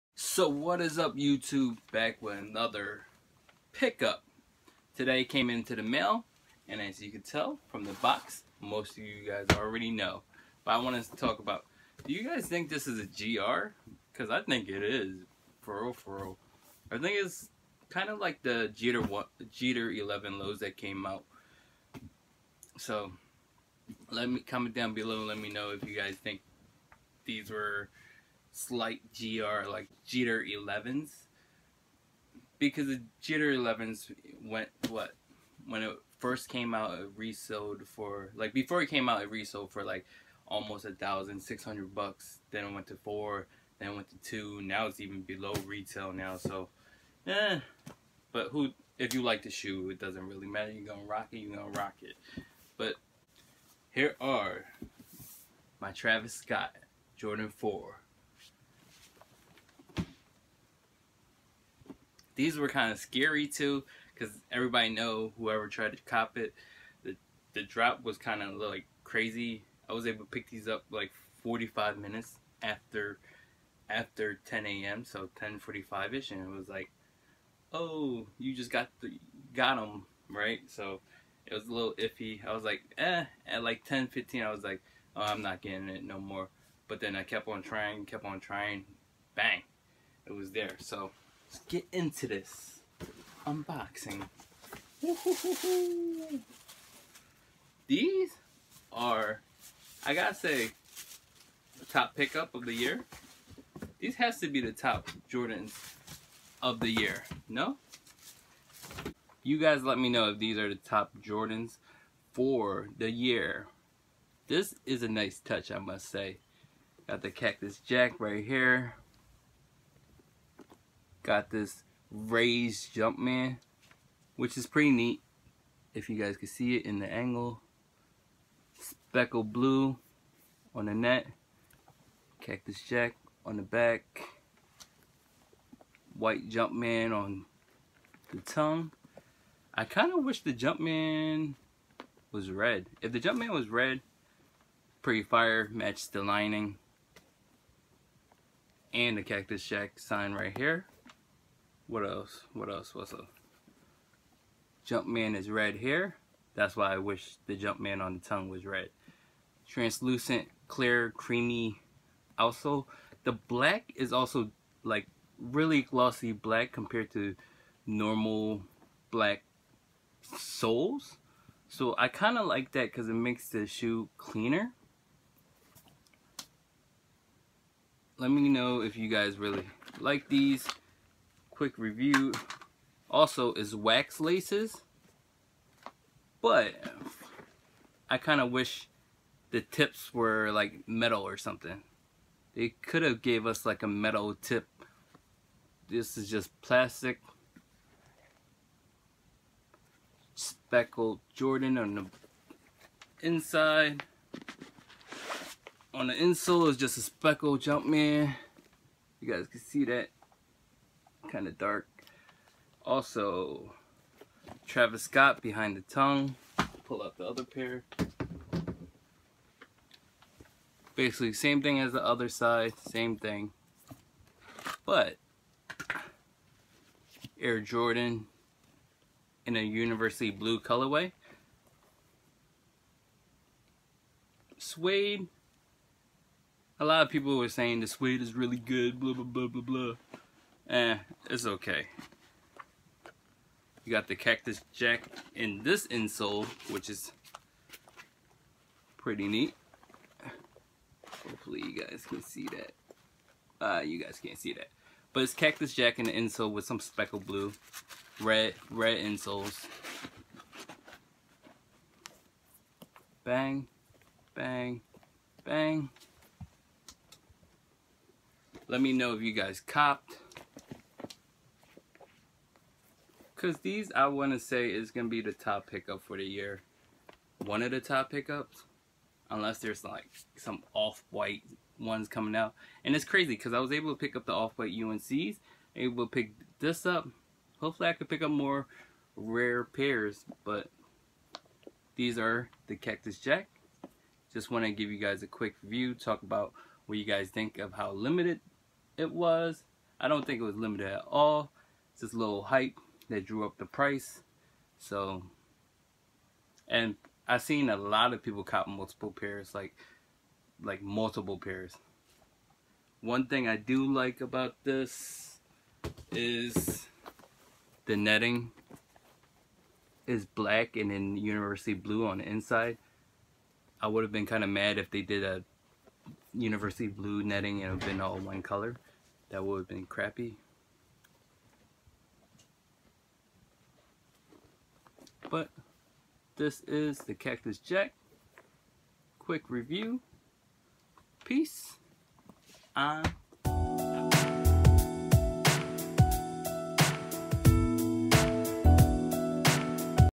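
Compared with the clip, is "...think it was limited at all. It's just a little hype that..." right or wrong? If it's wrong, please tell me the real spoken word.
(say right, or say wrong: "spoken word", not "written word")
right.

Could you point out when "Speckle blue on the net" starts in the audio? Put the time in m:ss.
2:08.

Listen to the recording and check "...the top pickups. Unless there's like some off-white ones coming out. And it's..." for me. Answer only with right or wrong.
right.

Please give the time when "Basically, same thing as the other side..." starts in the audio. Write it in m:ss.
3:40.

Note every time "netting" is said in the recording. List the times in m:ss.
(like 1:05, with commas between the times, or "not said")
5:17, 5:27.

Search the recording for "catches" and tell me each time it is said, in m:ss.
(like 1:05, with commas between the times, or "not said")
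not said.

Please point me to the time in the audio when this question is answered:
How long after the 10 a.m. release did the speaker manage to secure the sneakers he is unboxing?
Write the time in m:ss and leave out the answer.
1:11.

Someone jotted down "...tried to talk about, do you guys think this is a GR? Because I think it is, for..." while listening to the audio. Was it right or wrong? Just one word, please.
wrong.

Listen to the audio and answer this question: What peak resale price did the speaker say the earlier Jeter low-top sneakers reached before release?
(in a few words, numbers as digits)
almost a thousand.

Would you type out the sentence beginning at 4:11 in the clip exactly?
Hopefully you guys can see that.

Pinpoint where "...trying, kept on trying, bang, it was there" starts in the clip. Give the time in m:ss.
1:27.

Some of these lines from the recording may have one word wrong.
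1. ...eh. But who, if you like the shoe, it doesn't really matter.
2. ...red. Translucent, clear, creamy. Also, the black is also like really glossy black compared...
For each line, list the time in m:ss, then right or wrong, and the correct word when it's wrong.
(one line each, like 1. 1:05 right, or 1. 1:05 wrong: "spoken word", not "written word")
1. 0:47 right
2. 2:38 right.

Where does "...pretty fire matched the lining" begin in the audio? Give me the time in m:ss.
2:25.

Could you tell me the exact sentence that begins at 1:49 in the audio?
You guys let me know if these are the top Jordans for the year.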